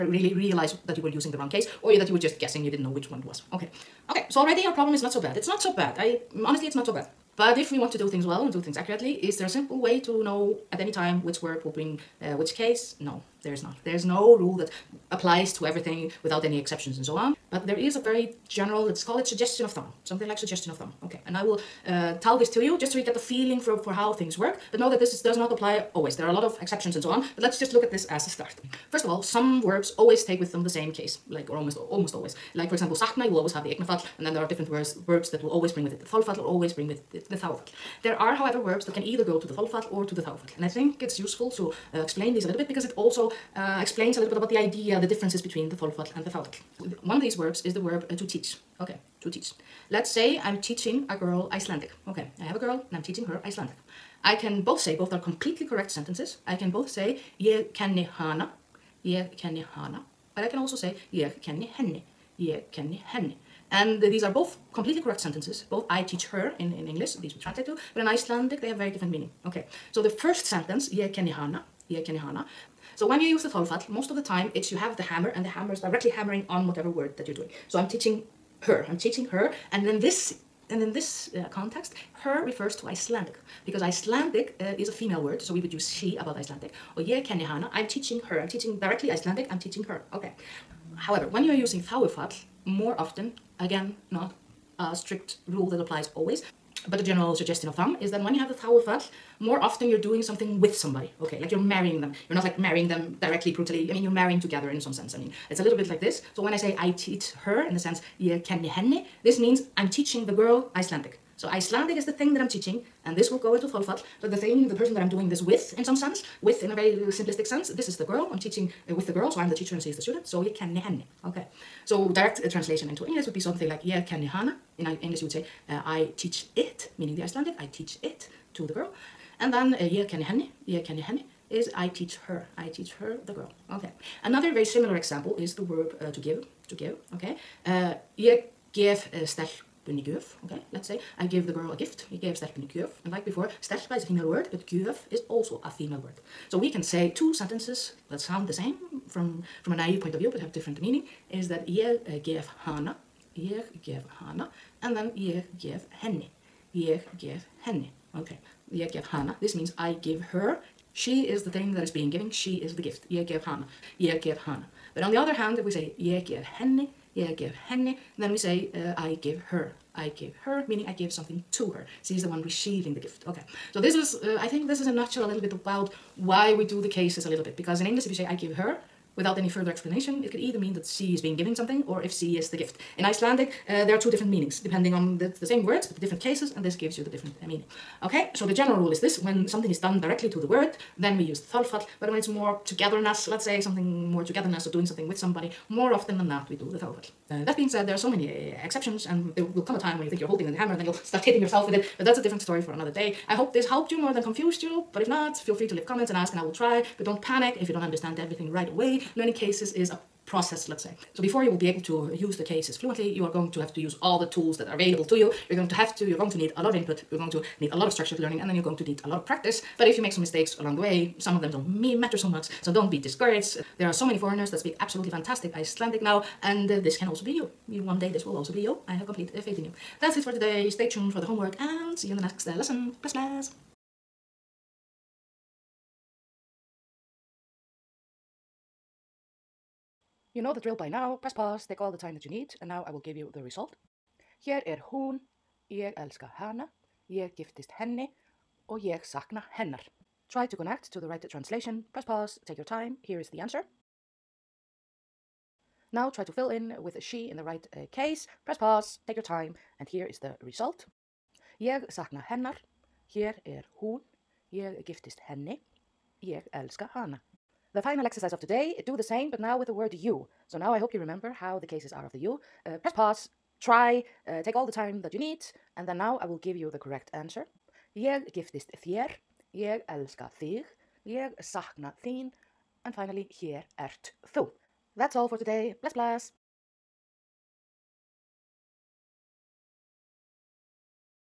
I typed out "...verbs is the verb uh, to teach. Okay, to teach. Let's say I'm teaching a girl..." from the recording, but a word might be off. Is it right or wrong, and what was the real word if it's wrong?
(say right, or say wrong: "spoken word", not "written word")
right.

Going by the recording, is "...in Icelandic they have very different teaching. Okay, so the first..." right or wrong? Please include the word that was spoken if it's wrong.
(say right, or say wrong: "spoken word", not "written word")
wrong: "meaning", not "teaching".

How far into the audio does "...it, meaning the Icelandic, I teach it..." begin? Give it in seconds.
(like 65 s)
126 s.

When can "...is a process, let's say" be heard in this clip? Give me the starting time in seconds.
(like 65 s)
209 s.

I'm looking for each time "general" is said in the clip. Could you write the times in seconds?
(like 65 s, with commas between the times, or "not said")
18 s, 97 s, 188 s.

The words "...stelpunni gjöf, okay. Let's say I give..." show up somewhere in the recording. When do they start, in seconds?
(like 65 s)
139 s.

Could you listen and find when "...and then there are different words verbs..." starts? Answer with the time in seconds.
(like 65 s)
34 s.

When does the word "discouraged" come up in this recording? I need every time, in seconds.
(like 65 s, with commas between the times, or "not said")
223 s.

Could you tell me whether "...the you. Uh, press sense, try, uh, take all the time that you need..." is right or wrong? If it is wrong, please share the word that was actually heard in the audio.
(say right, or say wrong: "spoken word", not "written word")
wrong: "pause", not "sense".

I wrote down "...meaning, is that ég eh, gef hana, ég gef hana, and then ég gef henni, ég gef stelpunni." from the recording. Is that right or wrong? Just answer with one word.
wrong.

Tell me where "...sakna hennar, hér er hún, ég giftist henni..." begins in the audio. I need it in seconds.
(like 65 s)
261 s.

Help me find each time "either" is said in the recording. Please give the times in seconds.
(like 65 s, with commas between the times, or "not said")
39 s, 180 s.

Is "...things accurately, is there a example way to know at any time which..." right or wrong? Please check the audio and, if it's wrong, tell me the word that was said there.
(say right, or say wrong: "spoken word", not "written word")
wrong: "simple", not "example".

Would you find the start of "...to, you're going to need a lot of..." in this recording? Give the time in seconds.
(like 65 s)
215 s.